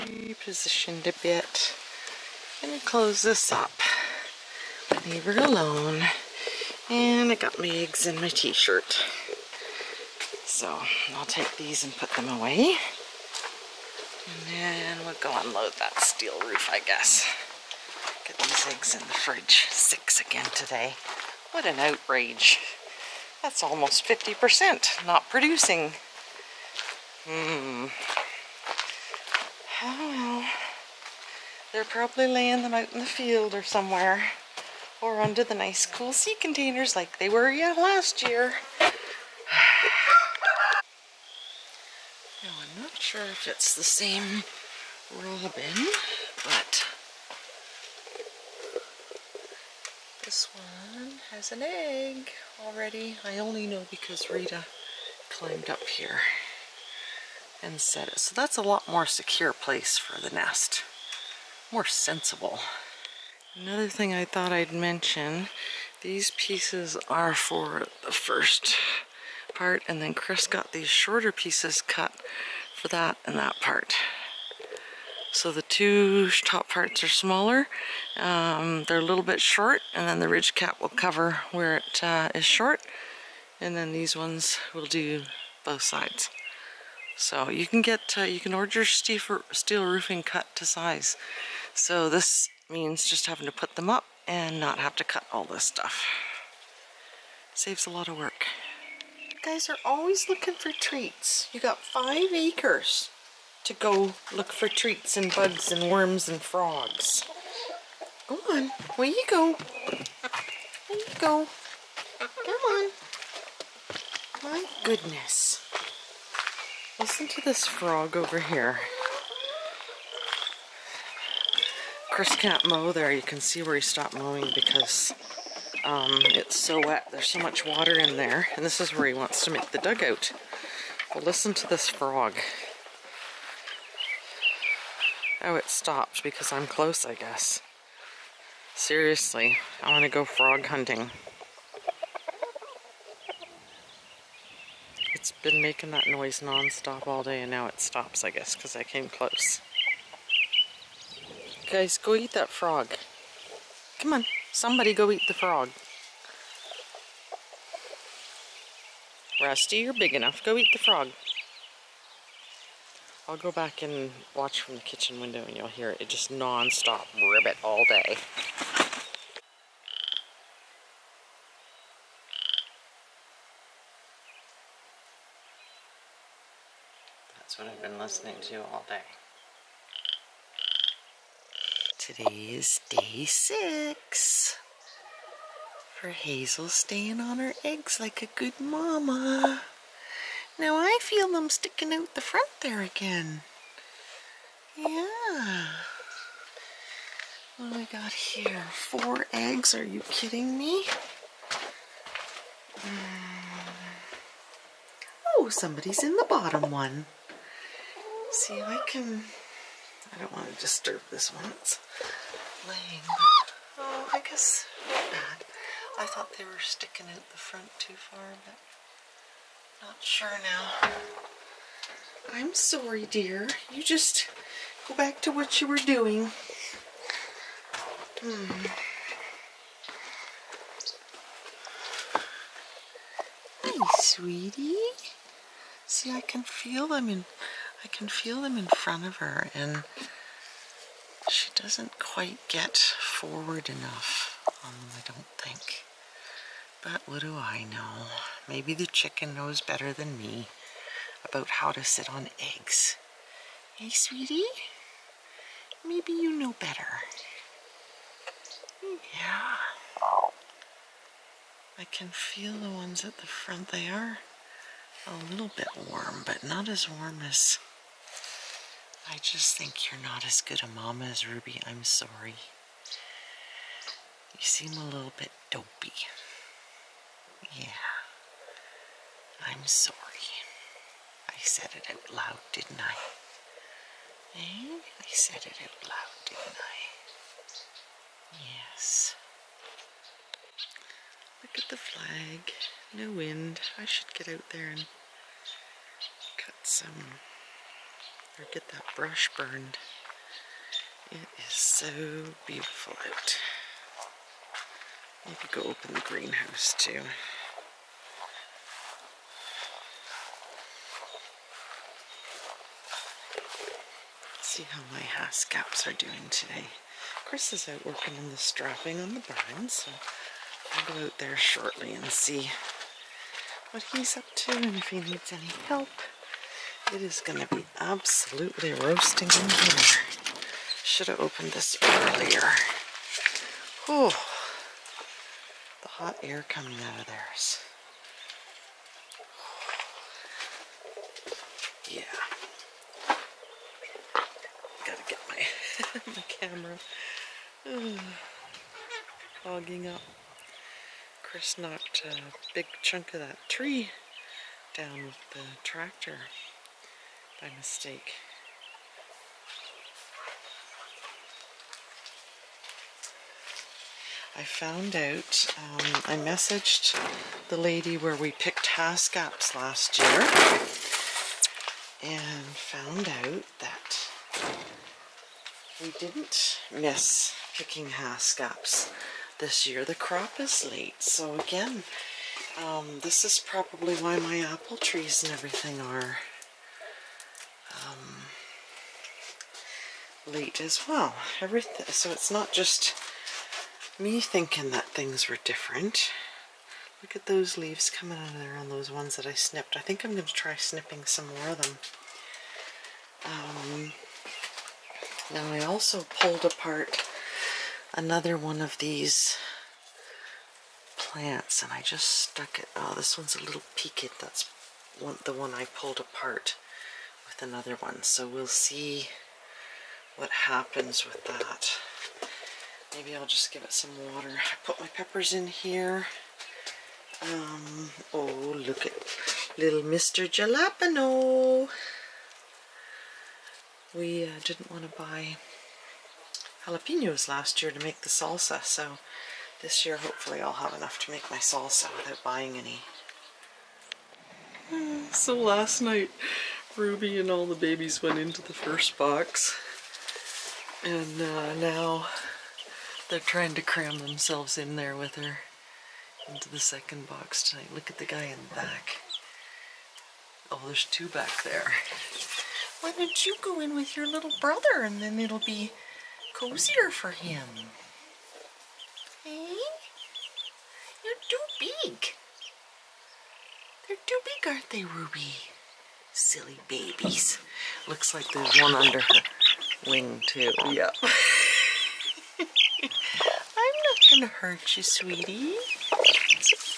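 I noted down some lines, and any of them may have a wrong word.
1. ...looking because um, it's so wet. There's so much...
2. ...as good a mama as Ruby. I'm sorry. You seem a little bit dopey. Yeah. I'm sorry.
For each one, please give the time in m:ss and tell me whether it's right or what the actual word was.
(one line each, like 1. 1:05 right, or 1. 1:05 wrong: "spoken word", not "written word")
1. 2:04 wrong: "mowing", not "looking"
2. 4:30 right.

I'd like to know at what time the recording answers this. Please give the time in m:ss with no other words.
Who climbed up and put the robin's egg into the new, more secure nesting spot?
0:54.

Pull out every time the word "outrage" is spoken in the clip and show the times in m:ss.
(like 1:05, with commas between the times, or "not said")
0:21.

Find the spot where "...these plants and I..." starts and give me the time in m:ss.
6:48.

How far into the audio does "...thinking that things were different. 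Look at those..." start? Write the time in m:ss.
6:34.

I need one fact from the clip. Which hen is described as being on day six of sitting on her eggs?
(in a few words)
Hazel.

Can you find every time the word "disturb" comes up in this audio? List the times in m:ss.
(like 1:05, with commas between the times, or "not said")
3:30.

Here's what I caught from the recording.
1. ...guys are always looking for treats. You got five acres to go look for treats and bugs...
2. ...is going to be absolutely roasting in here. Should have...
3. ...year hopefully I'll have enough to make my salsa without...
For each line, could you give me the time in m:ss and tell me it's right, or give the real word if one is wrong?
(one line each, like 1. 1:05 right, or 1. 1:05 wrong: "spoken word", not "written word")
1. 1:39 right
2. 5:27 right
3. 7:19 right.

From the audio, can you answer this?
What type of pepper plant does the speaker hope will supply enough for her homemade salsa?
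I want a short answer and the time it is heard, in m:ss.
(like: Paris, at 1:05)
Jalapeno, at 7:10.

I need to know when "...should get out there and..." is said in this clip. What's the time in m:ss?
4:53.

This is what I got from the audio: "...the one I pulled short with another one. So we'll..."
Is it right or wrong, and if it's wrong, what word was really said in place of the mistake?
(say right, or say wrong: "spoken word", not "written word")
wrong: "apart", not "short".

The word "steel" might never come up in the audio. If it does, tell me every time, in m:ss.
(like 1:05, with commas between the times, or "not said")
0:16, 1:28.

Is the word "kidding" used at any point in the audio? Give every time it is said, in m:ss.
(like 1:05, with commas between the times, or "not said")
3:20.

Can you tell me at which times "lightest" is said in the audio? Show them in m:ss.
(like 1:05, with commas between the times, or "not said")
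not said.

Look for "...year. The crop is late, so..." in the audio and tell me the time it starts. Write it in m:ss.
6:19.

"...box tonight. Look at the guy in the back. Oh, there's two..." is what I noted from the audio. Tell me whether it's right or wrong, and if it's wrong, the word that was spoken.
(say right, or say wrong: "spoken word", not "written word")
right.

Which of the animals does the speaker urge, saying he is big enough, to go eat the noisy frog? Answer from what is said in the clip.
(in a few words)
Rusty.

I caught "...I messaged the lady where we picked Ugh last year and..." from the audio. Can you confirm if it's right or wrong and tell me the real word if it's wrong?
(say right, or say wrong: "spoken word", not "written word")
wrong: "Haskaps", not "Ugh".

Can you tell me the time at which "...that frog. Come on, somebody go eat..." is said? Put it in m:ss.
2:32.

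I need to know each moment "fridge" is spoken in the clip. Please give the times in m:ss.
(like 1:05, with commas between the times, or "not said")
0:19.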